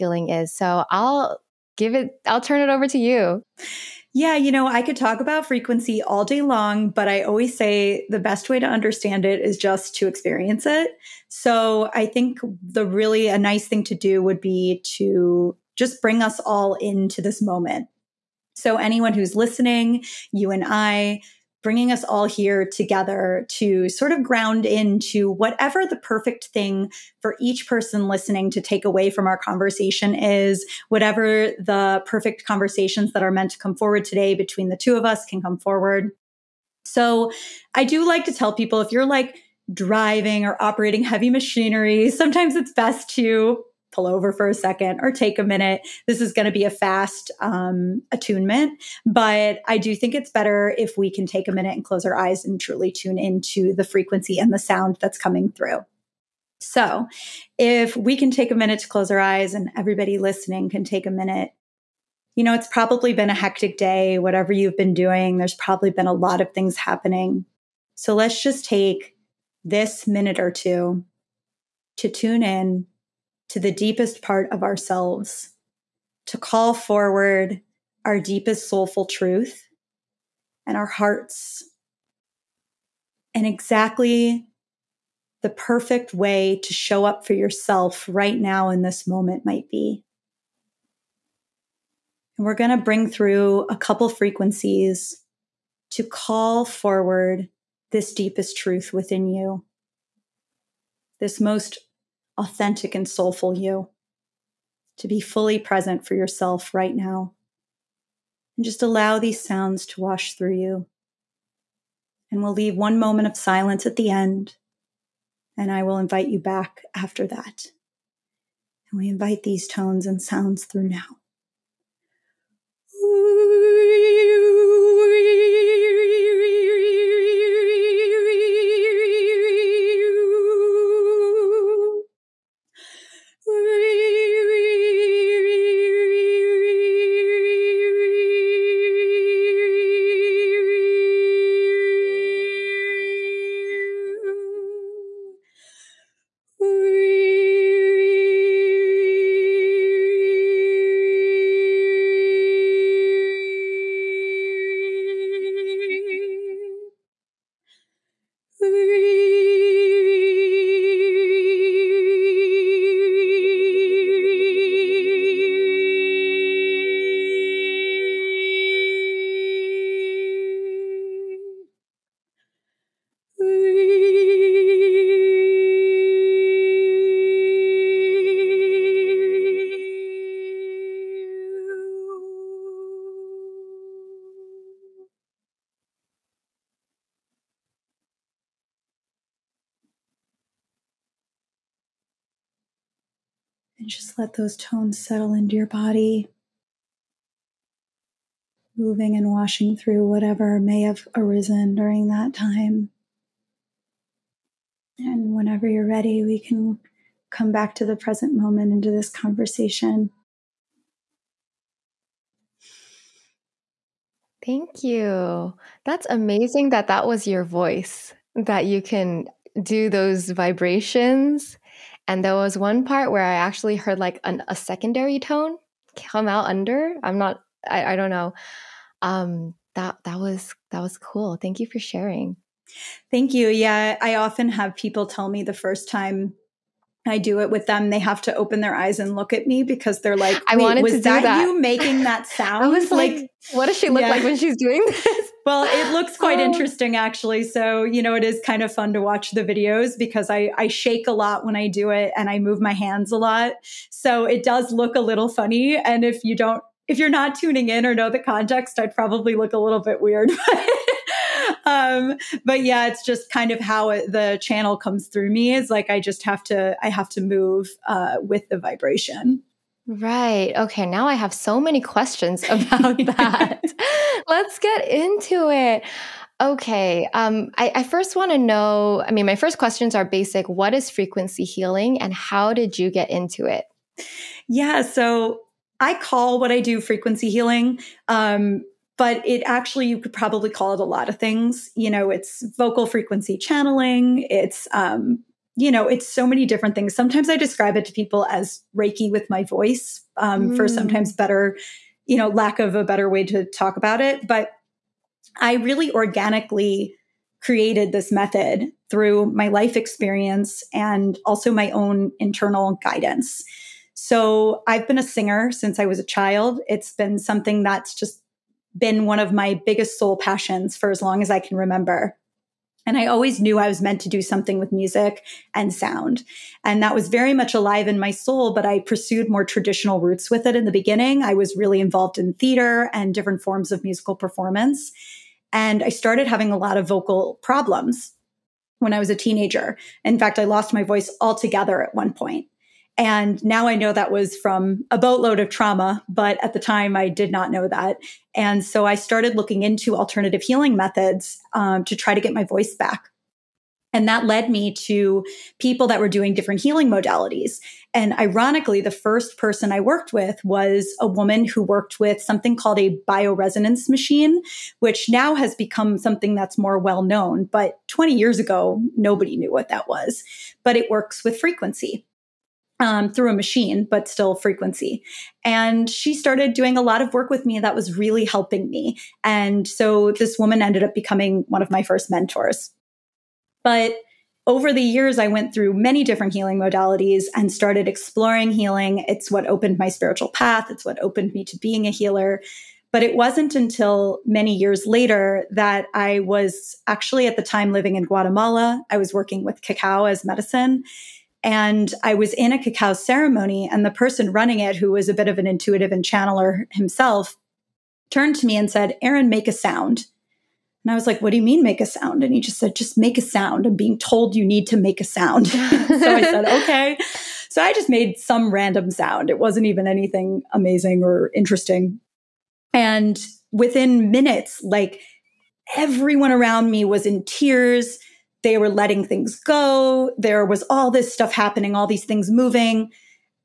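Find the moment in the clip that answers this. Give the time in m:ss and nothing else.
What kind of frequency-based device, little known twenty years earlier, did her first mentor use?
6:03.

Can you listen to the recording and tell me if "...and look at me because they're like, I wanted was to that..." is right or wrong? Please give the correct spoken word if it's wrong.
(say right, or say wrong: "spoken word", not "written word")
right.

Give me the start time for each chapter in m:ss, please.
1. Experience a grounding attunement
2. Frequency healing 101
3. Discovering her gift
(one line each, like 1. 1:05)
1. 0:56
2. 4:44
3. 6:23.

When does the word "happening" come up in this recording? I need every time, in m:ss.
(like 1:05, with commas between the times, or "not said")
1:06, 7:11.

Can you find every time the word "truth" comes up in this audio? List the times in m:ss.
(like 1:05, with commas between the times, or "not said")
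1:19, 1:38.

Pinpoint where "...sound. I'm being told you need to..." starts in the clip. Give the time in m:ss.
6:53.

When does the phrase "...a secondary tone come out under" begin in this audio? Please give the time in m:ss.
3:44.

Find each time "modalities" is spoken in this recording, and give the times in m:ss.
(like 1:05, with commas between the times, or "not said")
5:56, 6:26.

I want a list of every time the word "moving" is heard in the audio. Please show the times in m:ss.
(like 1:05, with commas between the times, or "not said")
3:18, 7:12.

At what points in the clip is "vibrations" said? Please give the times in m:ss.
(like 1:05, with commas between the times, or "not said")
3:40, 4:28.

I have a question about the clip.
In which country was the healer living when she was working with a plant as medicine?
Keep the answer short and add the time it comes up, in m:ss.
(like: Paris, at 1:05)
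Guatemala, at 6:38.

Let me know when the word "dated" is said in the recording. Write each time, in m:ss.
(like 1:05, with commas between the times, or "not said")
not said.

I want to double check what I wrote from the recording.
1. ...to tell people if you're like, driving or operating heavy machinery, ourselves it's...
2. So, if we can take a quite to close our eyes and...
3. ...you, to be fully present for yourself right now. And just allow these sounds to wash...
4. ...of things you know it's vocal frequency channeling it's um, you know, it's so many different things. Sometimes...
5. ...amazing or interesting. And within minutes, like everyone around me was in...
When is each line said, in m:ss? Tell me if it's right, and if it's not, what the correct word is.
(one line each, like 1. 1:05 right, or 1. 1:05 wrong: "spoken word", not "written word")
1. 0:38 wrong: "sometimes", not "ourselves"
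2. 0:56 wrong: "minute", not "quite"
3. 1:43 right
4. 4:51 right
5. 7:00 right.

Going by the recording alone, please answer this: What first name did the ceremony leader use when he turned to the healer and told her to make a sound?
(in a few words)
Erin.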